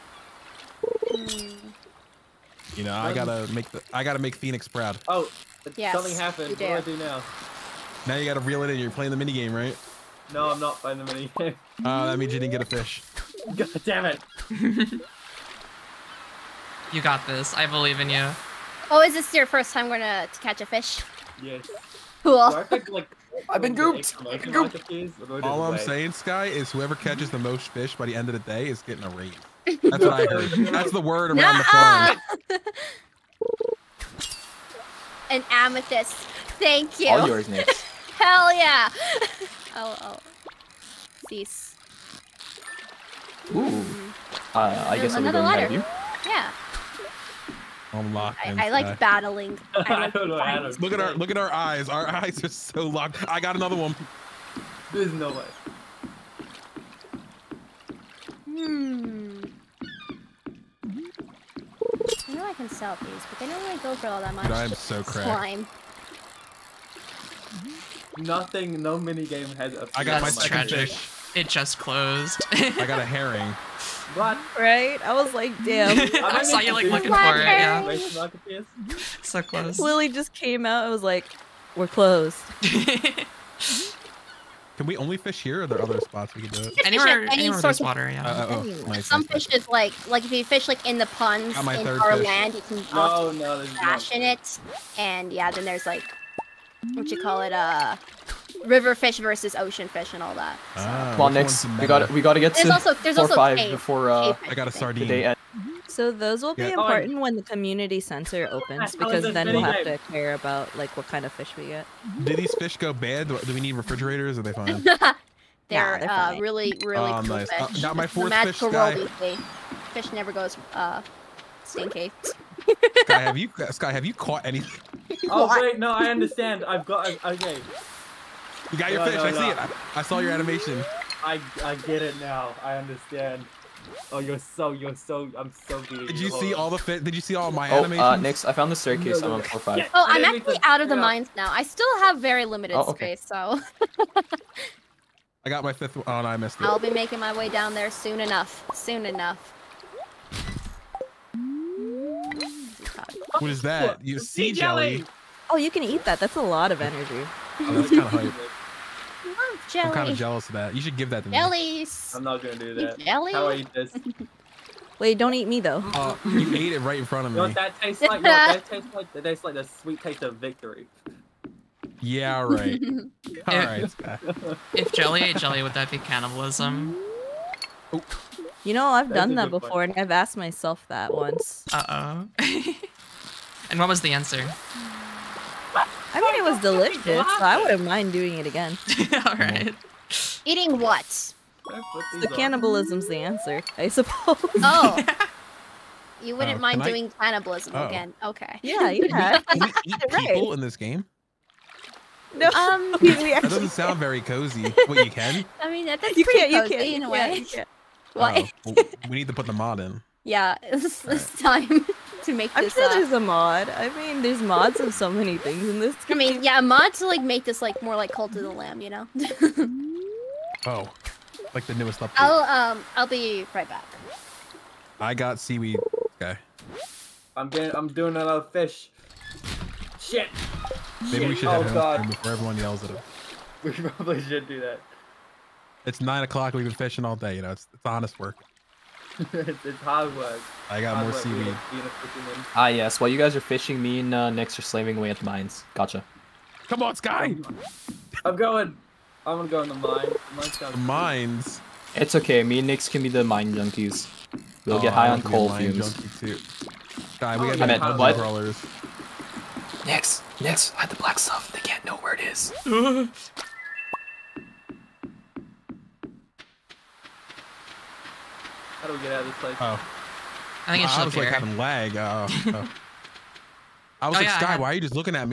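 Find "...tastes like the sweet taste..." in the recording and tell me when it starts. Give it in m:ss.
2:49.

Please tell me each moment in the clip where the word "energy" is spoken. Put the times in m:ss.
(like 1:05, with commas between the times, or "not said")
2:36.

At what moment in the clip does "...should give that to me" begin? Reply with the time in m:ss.
2:40.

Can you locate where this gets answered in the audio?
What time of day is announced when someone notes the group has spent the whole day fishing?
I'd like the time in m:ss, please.
3:56.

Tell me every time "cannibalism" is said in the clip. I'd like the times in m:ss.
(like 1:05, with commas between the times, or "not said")
2:55, 3:12, 3:17.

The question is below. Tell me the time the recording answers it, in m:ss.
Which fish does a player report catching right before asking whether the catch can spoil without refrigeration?
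1:44.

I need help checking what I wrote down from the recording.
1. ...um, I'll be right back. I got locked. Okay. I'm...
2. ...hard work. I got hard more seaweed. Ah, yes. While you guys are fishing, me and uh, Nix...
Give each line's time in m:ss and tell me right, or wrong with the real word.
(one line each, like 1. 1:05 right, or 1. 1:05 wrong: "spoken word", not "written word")
1. 3:42 wrong: "seaweed", not "locked"
2. 3:59 right.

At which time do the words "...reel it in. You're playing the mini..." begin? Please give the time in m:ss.
0:08.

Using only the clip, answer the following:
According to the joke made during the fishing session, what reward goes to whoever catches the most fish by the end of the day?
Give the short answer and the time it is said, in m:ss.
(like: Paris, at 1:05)
a raise, at 0:28.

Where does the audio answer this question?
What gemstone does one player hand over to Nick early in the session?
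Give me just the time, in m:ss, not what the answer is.
0:35.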